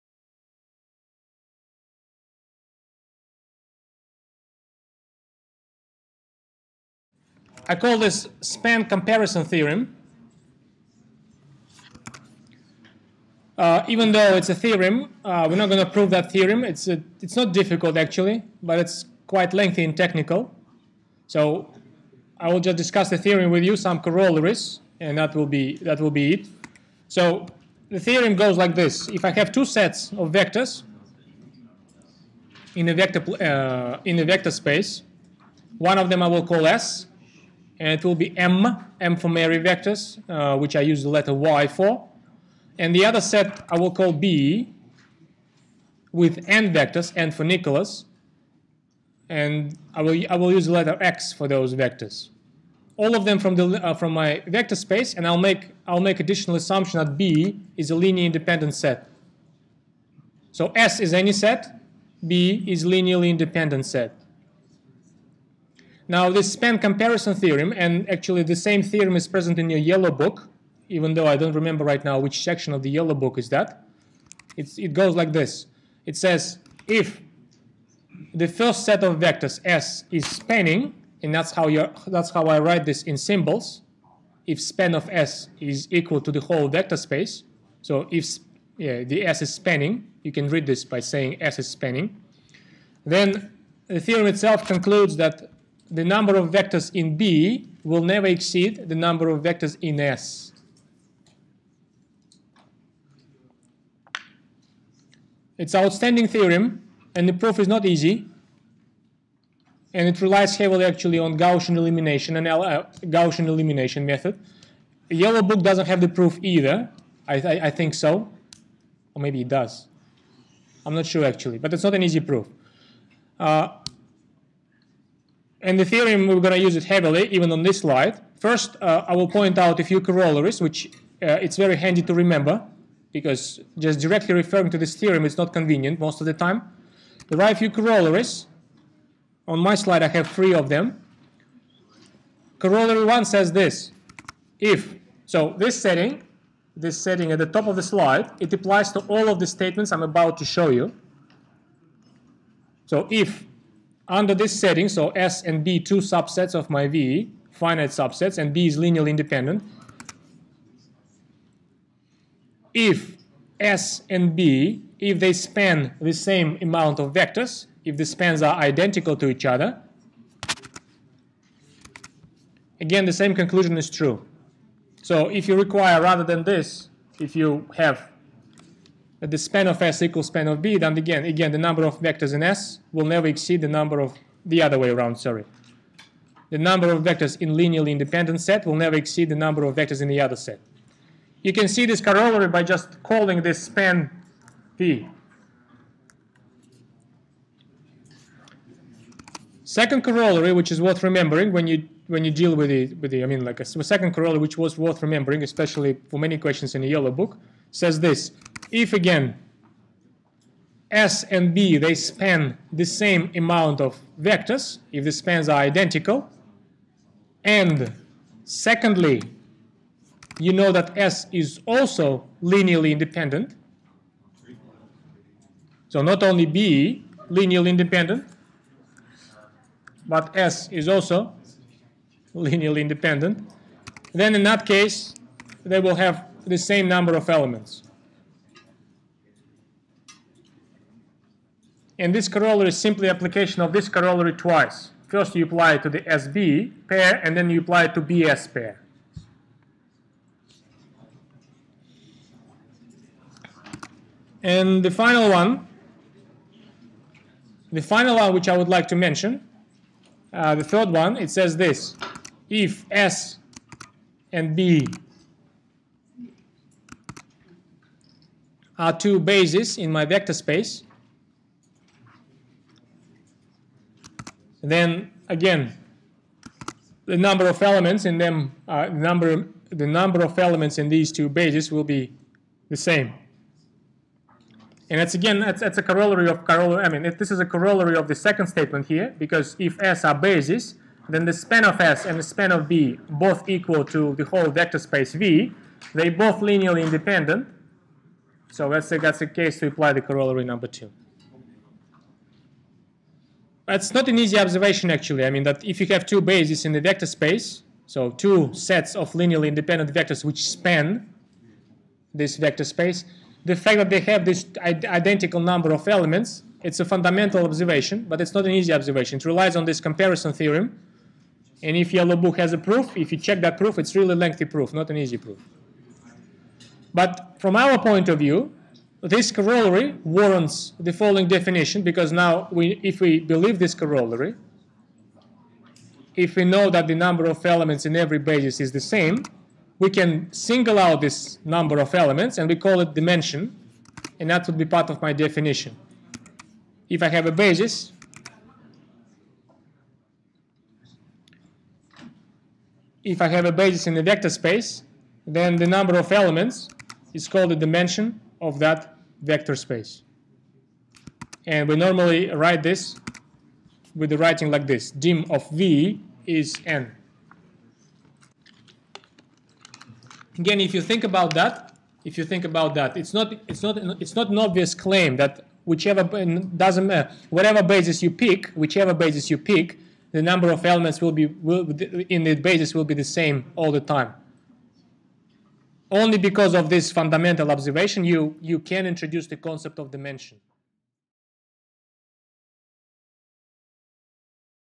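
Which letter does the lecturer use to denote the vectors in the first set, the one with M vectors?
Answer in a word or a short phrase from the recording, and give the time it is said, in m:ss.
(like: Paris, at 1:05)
Y, at 0:41.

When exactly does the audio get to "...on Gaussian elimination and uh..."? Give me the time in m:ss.
1:51.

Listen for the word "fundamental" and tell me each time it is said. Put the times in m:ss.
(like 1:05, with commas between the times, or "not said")
5:16, 6:26.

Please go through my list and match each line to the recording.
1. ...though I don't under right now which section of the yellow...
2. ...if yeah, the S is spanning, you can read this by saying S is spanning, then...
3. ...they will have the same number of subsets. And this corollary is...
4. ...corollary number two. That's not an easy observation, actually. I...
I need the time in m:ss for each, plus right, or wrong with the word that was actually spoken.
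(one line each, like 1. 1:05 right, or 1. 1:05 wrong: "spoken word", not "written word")
1. 1:11 wrong: "remember", not "under"
2. 1:28 right
3. 3:55 wrong: "elements", not "subsets"
4. 5:00 right.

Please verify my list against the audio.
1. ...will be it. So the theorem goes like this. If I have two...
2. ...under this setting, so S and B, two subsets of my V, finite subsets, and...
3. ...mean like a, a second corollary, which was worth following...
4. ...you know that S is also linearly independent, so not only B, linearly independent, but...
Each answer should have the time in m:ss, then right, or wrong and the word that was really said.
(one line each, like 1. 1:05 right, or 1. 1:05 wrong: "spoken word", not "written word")
1. 0:26 right
2. 2:34 right
3. 3:23 wrong: "remembering", not "following"
4. 3:40 right.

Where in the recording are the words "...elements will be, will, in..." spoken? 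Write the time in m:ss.
6:20.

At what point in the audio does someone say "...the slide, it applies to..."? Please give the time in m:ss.
2:27.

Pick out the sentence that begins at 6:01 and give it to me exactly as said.
And we normally write this with the writing like this.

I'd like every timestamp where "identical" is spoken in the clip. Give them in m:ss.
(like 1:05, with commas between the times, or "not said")
2:48, 3:35, 5:14.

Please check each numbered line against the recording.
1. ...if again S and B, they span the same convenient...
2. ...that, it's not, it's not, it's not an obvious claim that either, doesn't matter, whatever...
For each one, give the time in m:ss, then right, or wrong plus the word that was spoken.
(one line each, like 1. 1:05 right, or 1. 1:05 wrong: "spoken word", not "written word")
1. 3:28 wrong: "amount", not "convenient"
2. 6:12 wrong: "whichever", not "either".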